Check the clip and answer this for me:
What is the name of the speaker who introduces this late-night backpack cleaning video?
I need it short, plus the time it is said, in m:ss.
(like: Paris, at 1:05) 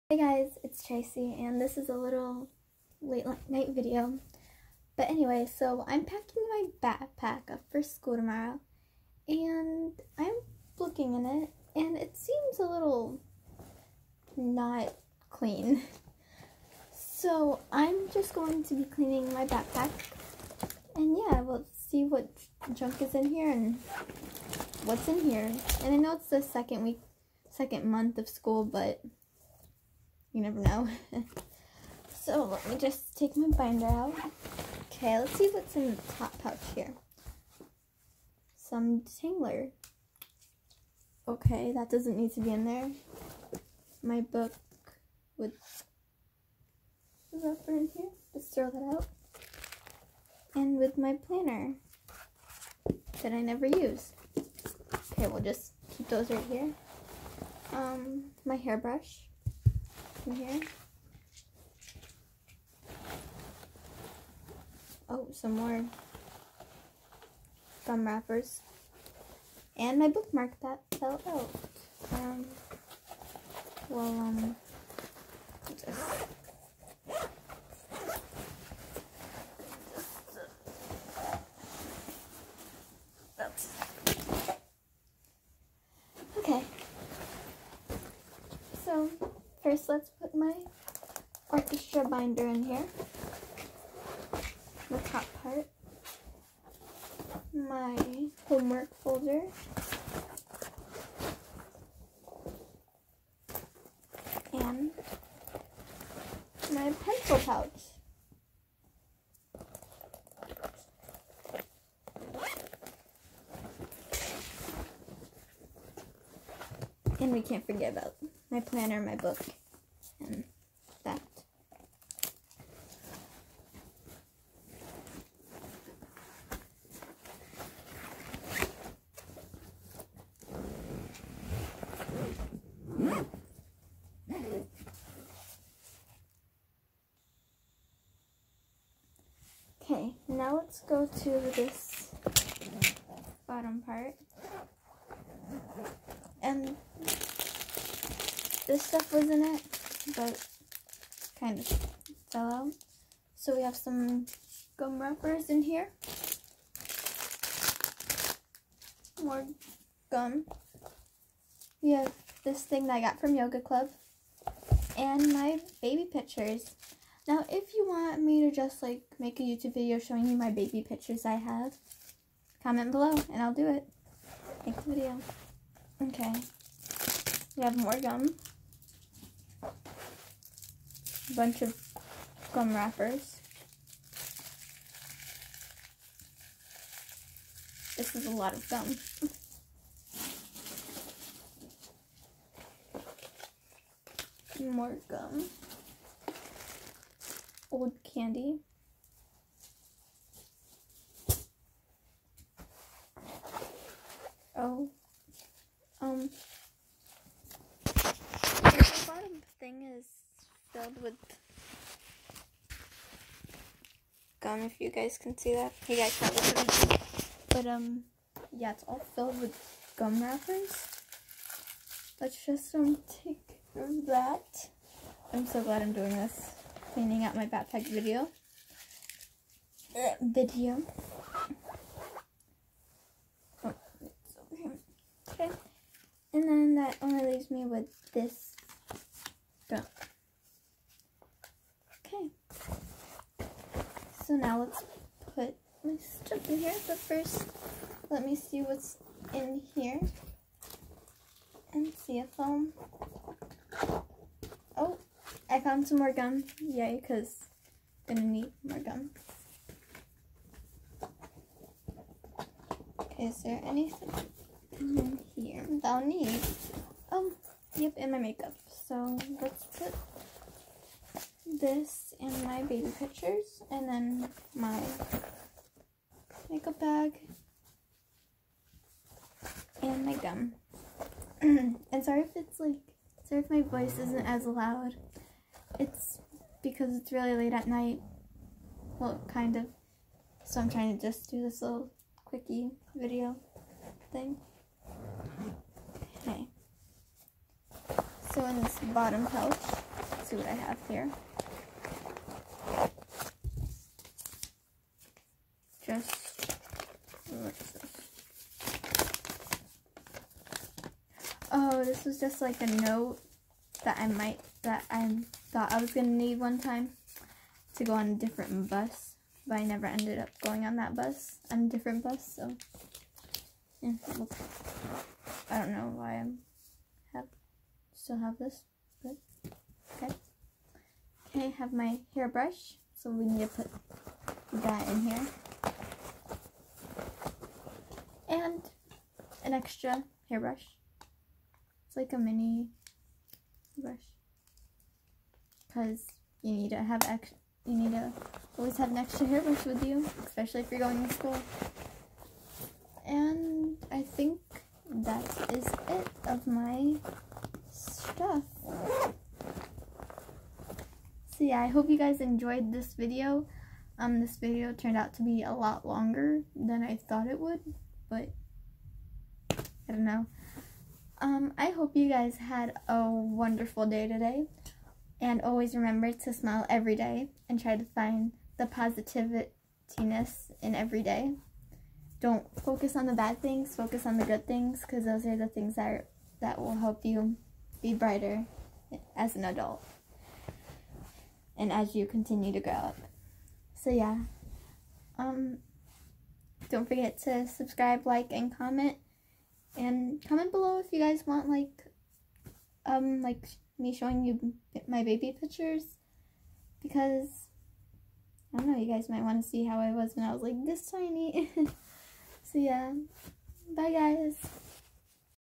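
Tracy, at 0:00.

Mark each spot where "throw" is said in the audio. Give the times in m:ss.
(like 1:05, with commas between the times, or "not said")
0:48.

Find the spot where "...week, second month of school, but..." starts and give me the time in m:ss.
0:26.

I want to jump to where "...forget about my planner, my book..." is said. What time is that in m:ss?
1:57.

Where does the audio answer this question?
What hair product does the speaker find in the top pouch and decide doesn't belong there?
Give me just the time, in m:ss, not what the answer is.
0:39.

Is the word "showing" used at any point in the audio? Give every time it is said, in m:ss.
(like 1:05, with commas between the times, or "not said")
2:49, 6:43.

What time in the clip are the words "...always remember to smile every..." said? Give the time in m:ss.
6:15.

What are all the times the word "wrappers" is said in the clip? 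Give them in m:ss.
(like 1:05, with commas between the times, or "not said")
1:08, 2:35, 3:02, 3:40.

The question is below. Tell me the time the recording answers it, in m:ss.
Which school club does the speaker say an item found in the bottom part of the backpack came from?
2:43.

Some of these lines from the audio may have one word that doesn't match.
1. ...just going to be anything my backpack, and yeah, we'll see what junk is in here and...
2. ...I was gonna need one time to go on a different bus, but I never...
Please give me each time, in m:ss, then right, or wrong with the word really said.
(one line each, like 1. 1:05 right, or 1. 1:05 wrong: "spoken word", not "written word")
1. 0:18 wrong: "cleaning", not "anything"
2. 5:15 right.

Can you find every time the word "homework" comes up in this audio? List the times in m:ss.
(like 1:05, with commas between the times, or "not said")
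1:38.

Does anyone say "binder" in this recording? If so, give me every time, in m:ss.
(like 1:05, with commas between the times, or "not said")
0:33, 1:32.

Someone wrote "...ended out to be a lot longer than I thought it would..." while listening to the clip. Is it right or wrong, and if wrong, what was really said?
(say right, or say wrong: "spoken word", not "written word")
wrong: "turned", not "ended".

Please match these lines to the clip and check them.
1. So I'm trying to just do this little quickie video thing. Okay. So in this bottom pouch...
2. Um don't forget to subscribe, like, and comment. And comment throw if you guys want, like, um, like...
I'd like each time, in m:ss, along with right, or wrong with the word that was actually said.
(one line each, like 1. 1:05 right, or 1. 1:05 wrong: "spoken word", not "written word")
1. 4:50 right
2. 6:35 wrong: "below", not "throw".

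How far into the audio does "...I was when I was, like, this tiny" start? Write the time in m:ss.
6:49.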